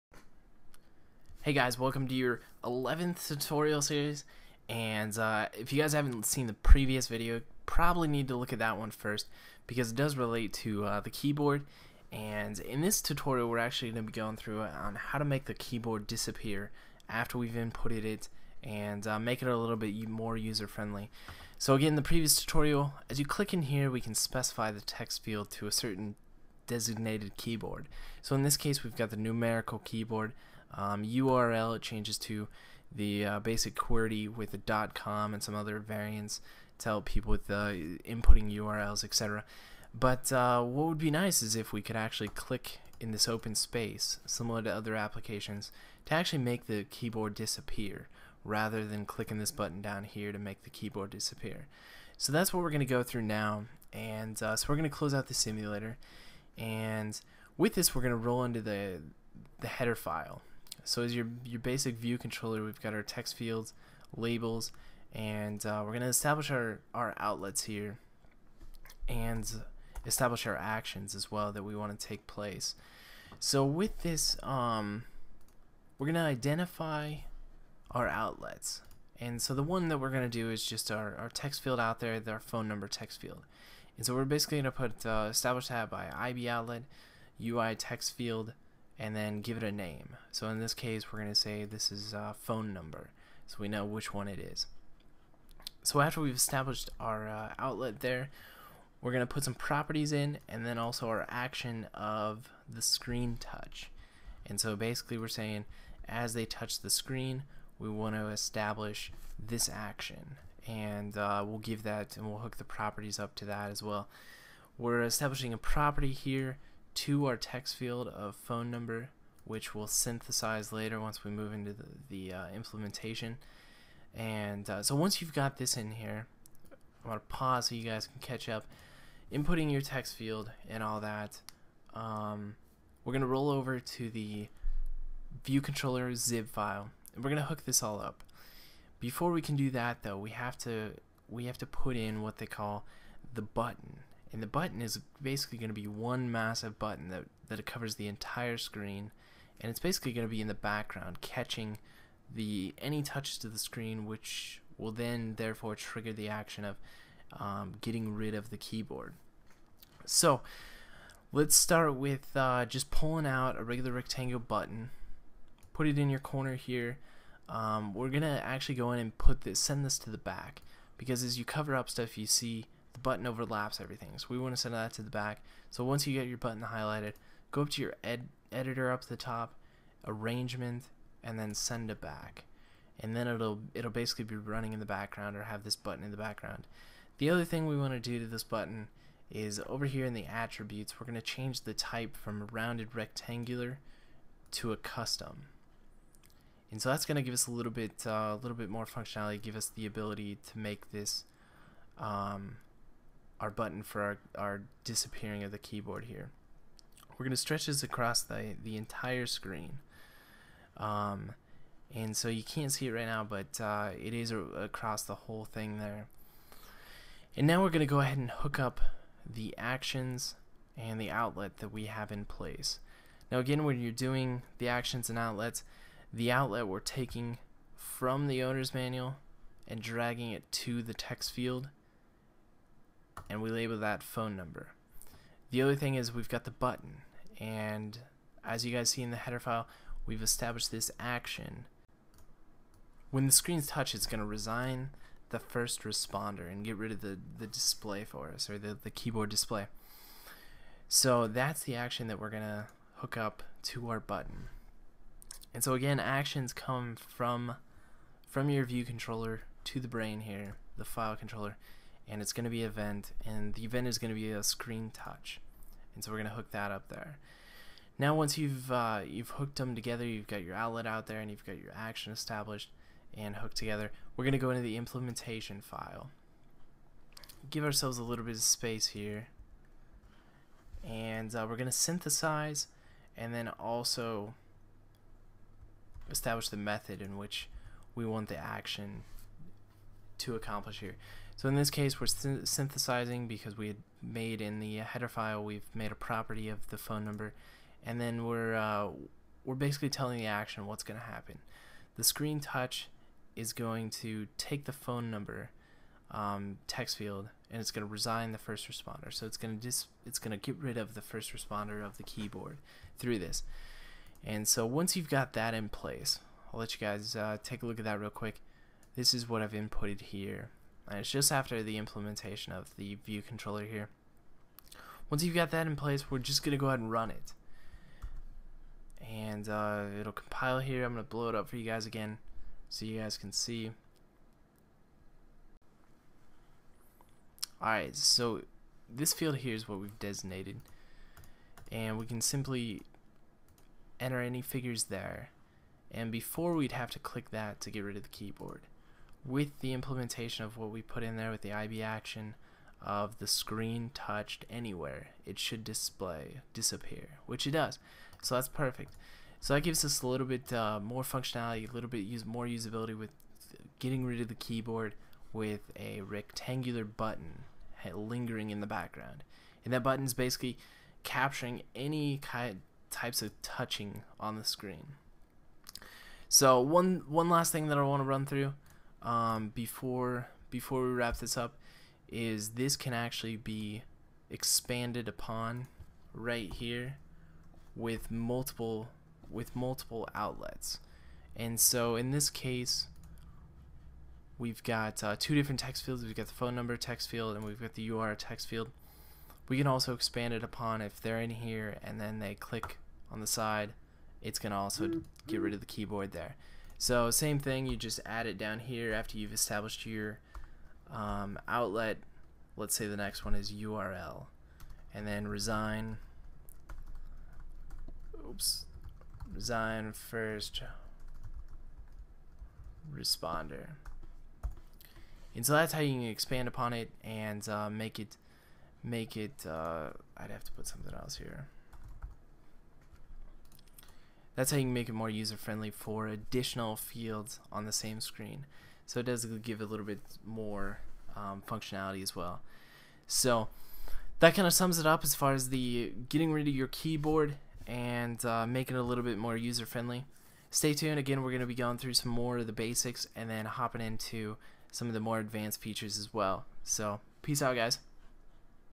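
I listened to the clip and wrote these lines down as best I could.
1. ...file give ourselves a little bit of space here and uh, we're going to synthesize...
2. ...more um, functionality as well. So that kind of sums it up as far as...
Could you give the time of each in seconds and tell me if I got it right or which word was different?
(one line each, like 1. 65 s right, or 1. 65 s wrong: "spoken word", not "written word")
1. 275 s right
2. 440 s right.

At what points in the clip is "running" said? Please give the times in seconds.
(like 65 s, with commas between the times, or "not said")
184 s.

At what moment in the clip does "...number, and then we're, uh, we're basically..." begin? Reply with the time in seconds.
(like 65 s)
297 s.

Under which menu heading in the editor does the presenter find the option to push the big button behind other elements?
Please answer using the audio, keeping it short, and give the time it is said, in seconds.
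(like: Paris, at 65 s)
arrangement, at 180 s.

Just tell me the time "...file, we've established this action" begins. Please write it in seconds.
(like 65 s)
239 s.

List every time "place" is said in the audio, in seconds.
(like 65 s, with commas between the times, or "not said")
72 s, 222 s, 315 s, 325 s.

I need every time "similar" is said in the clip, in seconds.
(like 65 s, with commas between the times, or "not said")
44 s.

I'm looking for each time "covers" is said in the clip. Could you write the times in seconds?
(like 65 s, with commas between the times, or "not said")
147 s, 171 s.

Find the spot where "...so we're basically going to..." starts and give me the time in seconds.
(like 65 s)
84 s.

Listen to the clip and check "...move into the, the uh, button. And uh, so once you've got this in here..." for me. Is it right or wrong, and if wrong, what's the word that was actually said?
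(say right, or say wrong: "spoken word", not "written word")
wrong: "implementation", not "button".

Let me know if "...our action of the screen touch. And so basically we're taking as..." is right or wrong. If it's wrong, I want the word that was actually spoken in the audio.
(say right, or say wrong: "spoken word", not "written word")
wrong: "saying", not "taking".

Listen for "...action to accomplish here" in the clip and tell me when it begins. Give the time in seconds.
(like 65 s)
288 s.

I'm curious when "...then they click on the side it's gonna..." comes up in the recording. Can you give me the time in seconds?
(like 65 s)
401 s.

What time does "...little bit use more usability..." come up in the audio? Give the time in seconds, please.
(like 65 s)
361 s.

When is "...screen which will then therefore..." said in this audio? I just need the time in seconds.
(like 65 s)
153 s.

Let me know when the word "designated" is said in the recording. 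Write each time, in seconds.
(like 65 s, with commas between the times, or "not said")
26 s, 339 s.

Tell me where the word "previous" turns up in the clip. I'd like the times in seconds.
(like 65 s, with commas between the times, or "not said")
6 s, 22 s.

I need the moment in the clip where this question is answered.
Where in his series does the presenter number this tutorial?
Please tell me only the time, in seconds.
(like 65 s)
2 s.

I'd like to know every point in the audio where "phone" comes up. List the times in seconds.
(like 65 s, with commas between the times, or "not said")
82 s, 92 s, 118 s, 234 s, 296 s, 304 s, 396 s.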